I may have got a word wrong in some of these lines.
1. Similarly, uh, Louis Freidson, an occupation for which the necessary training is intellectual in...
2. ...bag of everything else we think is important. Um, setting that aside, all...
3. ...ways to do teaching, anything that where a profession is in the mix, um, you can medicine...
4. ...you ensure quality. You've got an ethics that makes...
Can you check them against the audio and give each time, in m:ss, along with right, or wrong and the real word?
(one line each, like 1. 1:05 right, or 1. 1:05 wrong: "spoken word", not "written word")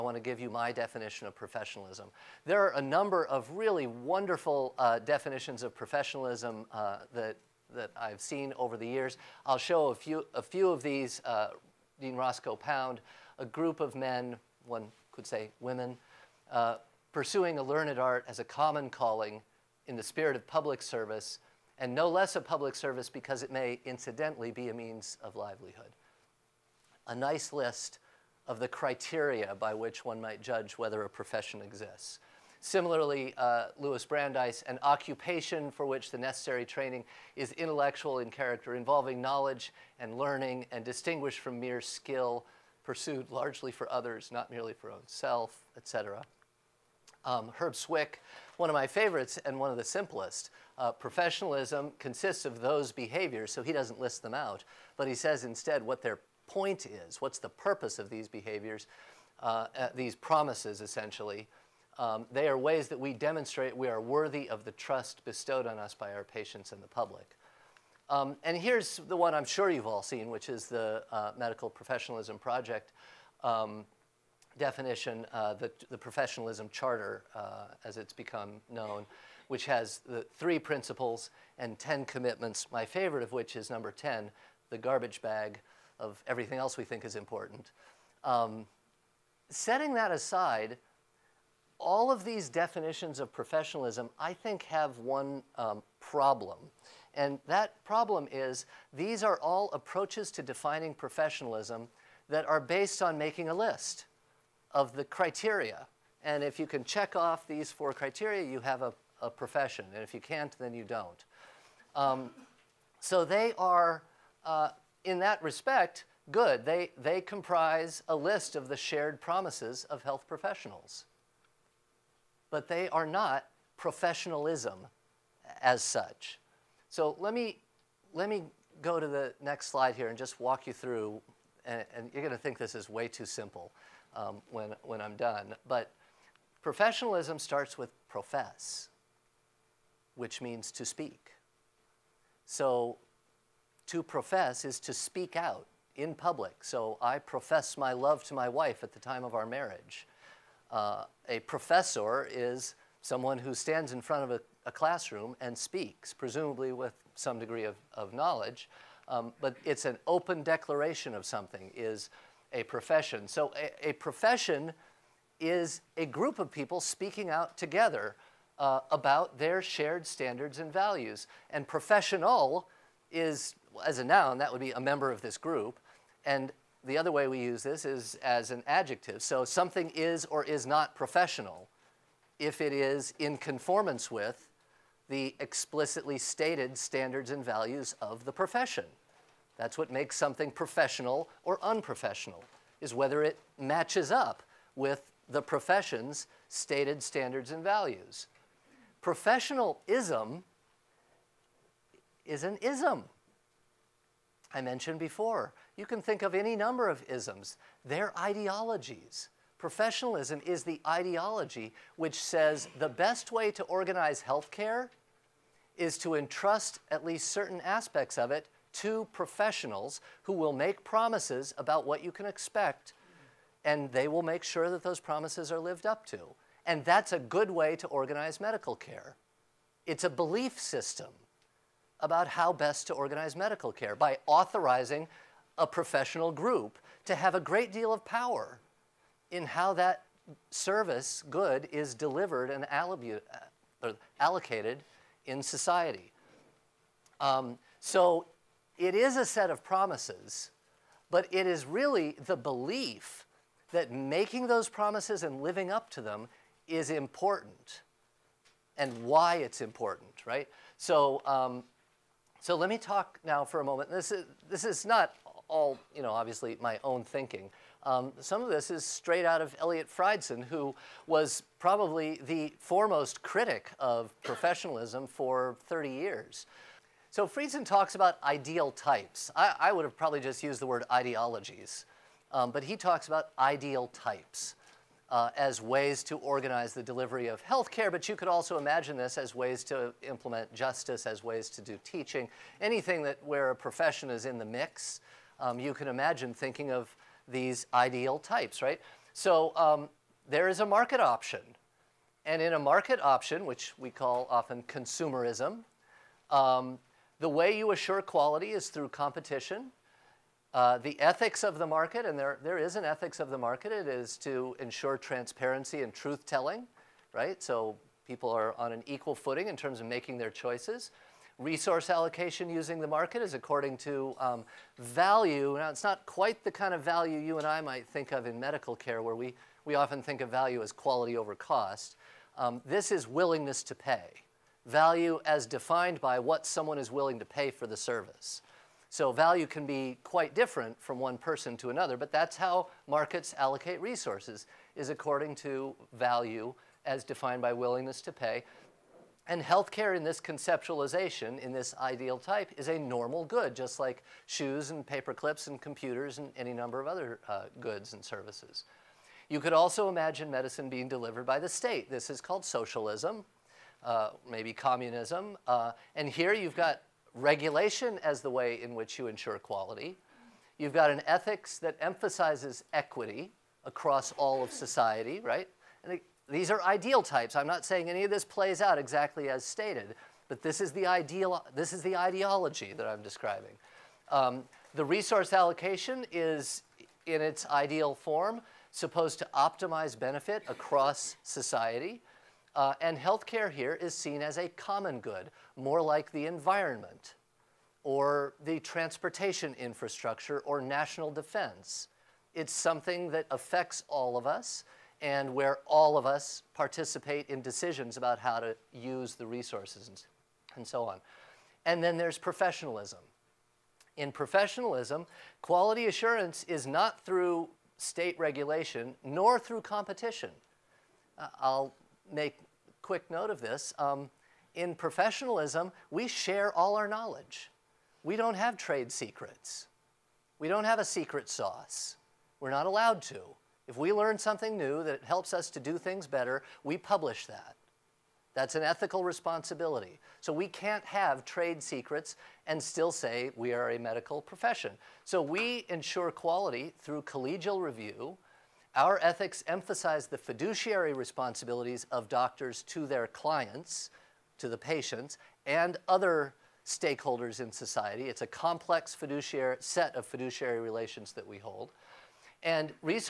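1. 0:32 wrong: "Brandeis", not "Freidson"
2. 1:25 right
3. 4:51 wrong: "imagine", not "medicine"
4. 6:08 wrong: "emphasizes", not "makes".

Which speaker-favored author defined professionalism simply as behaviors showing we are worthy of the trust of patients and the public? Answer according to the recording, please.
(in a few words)
Herb Swick.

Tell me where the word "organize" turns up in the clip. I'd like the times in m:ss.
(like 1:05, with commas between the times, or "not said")
3:33, 3:47, 3:52, 4:46.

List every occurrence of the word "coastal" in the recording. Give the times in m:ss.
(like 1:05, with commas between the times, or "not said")
not said.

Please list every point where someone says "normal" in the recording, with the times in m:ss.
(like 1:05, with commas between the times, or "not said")
5:52.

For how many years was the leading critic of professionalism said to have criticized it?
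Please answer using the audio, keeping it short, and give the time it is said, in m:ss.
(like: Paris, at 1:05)
30, at 4:35.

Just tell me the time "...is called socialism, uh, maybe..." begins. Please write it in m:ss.
6:02.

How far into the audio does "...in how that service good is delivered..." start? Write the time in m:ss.
3:59.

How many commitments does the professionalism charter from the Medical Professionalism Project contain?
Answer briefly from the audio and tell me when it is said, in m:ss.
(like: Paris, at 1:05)
10, at 1:21.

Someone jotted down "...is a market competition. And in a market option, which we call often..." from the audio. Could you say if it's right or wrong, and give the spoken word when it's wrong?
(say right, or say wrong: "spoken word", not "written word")
wrong: "option", not "competition".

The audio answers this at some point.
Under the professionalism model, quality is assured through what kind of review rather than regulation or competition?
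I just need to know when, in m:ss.
7:27.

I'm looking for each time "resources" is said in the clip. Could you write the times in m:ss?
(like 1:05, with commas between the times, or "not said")
5:21, 5:43, 6:24, 6:49.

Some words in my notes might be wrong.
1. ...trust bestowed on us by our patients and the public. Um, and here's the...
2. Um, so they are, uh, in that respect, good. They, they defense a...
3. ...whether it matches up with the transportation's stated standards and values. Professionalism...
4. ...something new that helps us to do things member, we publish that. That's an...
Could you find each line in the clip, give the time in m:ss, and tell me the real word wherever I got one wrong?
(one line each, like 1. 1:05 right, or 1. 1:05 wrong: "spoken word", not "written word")
1. 1:04 right
2. 1:51 wrong: "comprise", not "defense"
3. 3:12 wrong: "profession", not "transportation"
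4. 7:14 wrong: "better", not "member".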